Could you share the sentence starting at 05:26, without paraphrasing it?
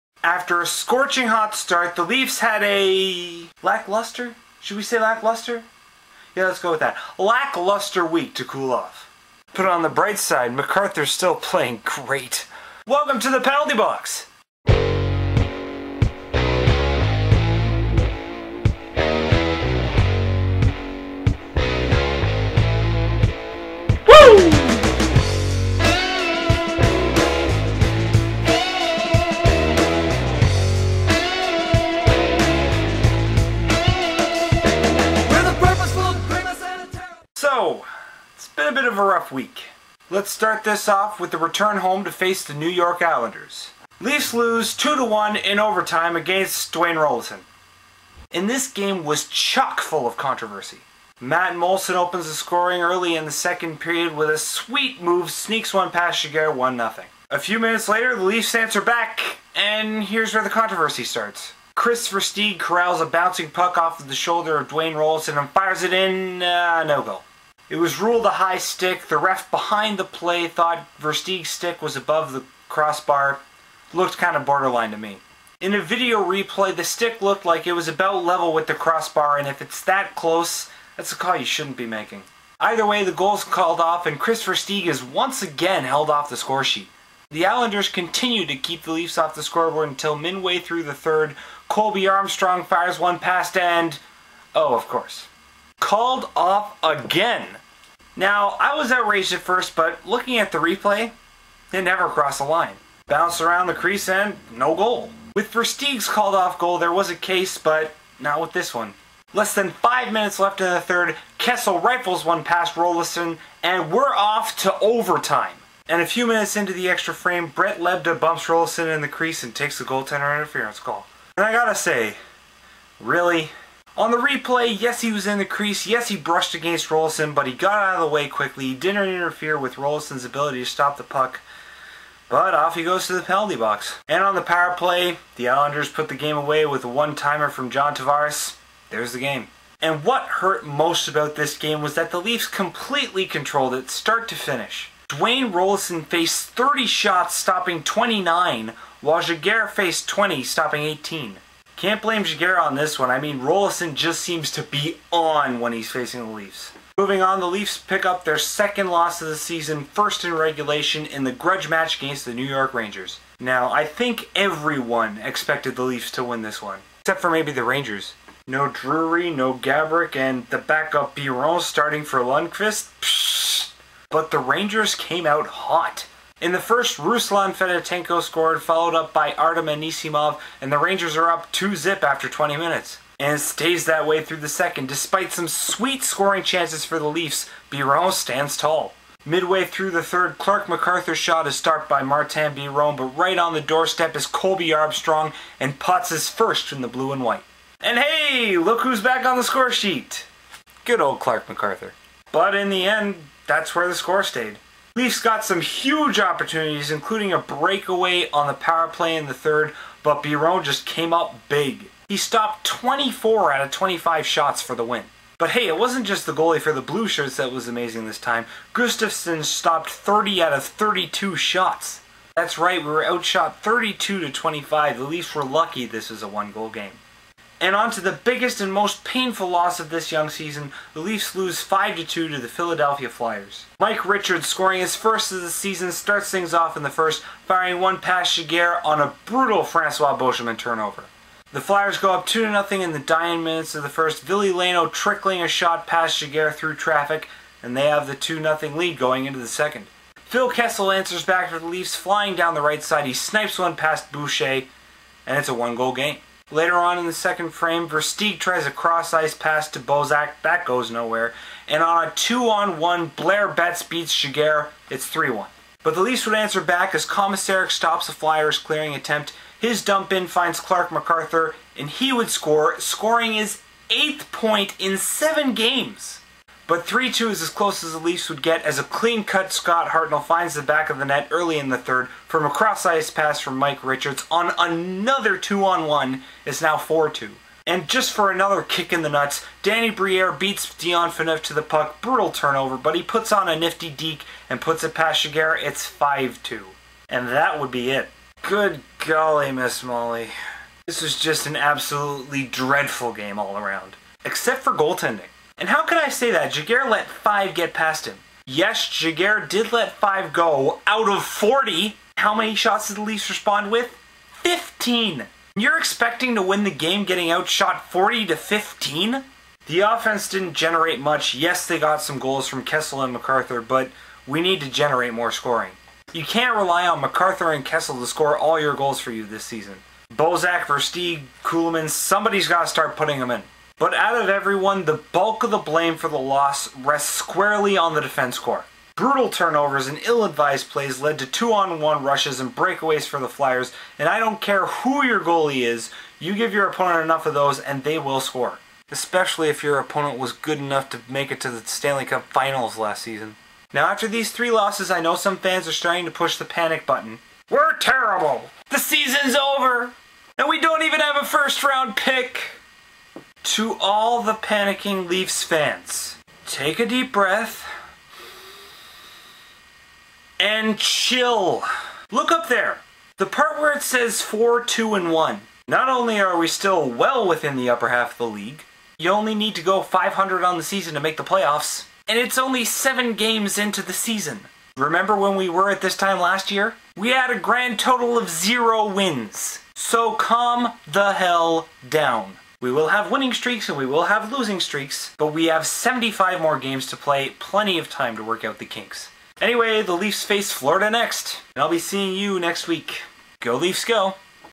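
You can't rely on MacArthur and Kessel to score all your goals for you this season.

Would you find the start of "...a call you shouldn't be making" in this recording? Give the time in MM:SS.
01:21.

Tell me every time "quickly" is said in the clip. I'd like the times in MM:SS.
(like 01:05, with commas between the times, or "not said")
02:08.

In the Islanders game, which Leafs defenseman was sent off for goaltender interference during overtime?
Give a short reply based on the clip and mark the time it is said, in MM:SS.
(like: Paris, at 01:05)
Brett Lebda, at 01:57.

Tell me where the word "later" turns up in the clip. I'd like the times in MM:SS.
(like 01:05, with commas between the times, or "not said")
00:57, 04:16.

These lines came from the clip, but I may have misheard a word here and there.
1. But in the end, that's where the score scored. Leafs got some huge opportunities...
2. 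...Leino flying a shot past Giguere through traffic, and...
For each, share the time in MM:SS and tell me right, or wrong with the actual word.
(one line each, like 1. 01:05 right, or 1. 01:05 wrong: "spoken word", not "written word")
1. 03:22 wrong: "stayed", not "scored"
2. 04:04 wrong: "trickling", not "flying".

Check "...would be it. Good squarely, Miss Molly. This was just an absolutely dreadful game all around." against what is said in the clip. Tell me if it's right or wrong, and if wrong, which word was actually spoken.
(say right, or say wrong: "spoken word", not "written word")
wrong: "golly", not "squarely".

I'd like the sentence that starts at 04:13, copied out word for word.
He snipes one past Boucher, and it's a one-goal game.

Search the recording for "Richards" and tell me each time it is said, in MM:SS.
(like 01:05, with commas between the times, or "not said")
03:54, 04:43.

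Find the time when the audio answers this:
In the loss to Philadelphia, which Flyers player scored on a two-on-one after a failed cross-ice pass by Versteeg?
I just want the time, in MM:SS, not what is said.
04:23.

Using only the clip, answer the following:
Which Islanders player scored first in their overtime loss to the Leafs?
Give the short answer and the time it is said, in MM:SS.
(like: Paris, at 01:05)
Matt Moulson, at 00:51.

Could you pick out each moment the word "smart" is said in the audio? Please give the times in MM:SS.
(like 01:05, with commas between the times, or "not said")
not said.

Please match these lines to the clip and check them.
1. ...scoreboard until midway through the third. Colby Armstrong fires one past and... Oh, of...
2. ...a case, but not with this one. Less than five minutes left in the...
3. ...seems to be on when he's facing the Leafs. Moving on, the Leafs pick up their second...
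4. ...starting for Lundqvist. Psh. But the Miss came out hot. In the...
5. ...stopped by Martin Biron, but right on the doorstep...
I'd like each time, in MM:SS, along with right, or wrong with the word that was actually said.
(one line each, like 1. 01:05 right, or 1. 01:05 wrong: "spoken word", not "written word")
1. 01:29 right
2. 01:47 right
3. 02:34 right
4. 02:51 wrong: "Rangers", not "Miss"
5. 03:11 right.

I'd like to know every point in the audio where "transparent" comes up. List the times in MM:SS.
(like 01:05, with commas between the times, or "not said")
not said.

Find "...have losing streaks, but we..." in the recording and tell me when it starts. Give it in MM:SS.
06:34.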